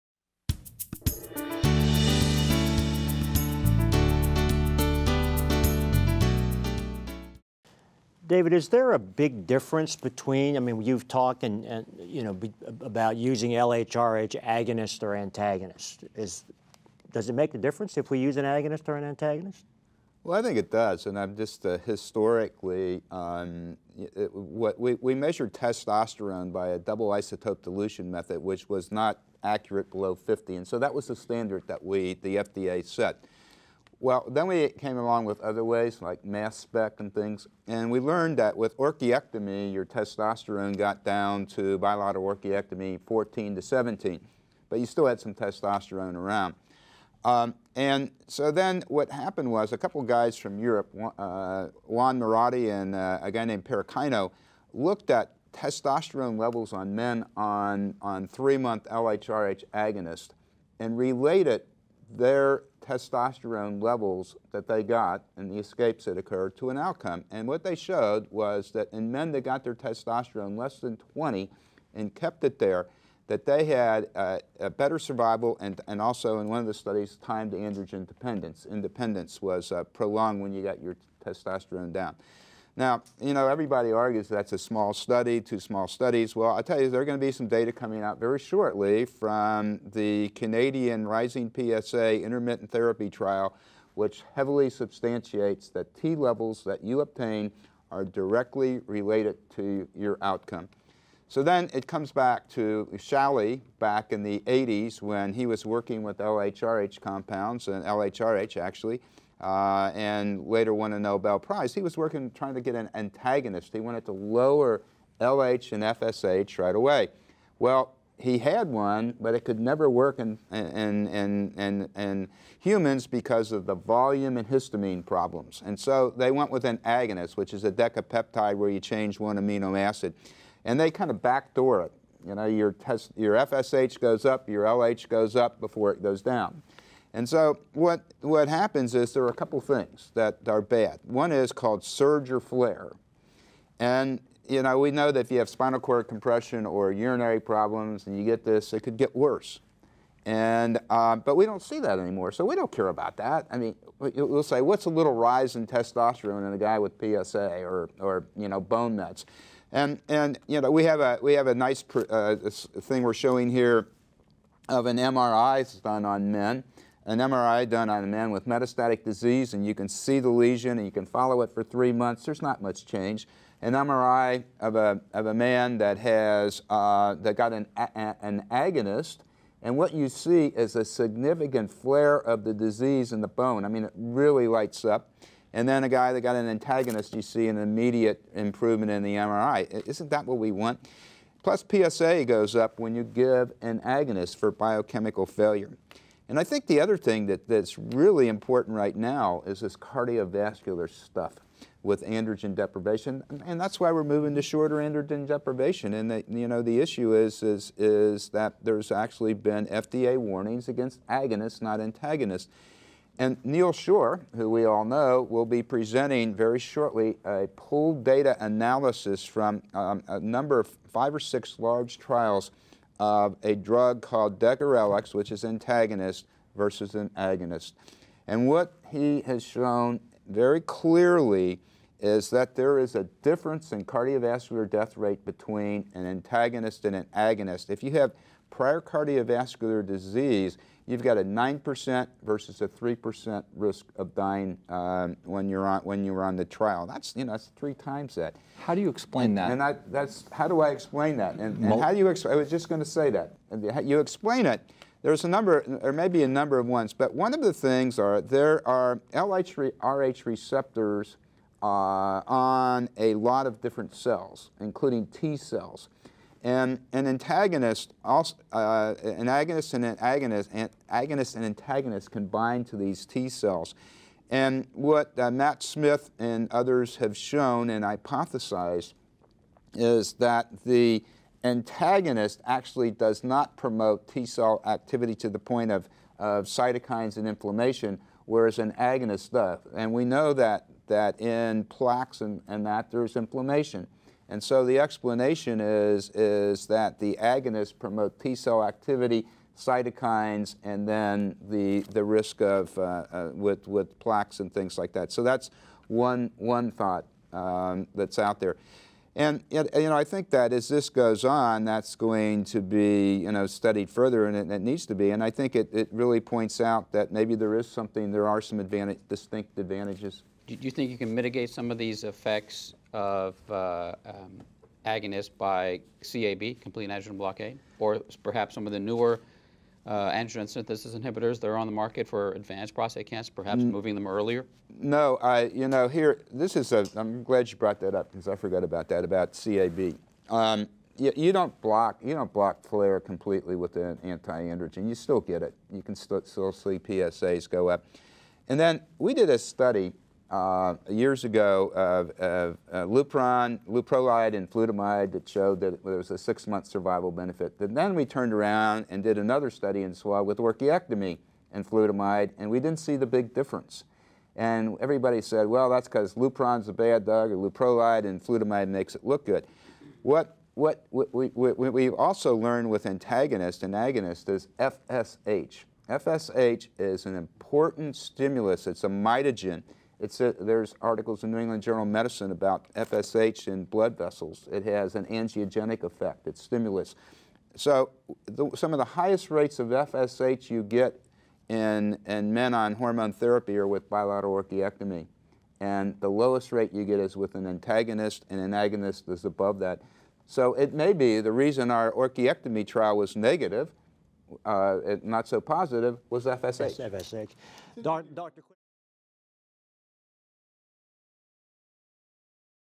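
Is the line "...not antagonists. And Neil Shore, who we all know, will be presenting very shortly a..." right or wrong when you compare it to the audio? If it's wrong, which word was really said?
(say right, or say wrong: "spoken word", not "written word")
right.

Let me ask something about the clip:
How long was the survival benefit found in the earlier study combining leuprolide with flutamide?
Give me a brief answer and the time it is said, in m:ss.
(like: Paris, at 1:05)
6 months, at 5:56.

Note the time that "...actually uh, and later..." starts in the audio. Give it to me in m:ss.
1:48.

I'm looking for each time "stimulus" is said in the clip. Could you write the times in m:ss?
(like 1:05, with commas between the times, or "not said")
6:17, 6:26.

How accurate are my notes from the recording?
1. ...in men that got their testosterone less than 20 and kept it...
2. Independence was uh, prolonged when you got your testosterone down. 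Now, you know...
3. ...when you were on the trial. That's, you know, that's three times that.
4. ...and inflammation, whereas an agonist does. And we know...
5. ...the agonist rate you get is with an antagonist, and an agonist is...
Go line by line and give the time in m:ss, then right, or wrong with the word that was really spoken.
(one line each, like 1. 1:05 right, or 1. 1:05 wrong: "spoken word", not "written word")
1. 1:08 right
2. 1:18 right
3. 4:05 right
4. 4:47 right
5. 6:36 wrong: "lowest", not "agonist".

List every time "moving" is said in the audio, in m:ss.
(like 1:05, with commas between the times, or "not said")
3:24, 5:33.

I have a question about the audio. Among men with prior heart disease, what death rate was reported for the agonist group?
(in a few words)
9%.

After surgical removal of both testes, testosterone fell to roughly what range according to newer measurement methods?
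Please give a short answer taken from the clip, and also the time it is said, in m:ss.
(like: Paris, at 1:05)
14 to 17, at 0:43.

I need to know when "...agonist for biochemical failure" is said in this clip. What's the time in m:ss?
3:13.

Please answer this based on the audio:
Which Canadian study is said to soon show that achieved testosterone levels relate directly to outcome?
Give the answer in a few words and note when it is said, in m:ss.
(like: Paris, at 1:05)
Rising PSA intermittent therapy trial, at 1:31.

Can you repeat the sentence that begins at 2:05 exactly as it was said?
And so they went with an agonist, which is a decapeptide where you change one amino acid.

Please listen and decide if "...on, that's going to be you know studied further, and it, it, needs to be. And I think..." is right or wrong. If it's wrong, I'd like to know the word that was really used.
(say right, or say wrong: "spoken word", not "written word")
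right.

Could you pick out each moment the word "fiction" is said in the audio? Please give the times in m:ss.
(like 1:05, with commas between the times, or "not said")
not said.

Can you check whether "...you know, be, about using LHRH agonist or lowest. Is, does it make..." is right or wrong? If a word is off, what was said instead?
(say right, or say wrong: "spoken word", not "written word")
wrong: "antagonist", not "lowest".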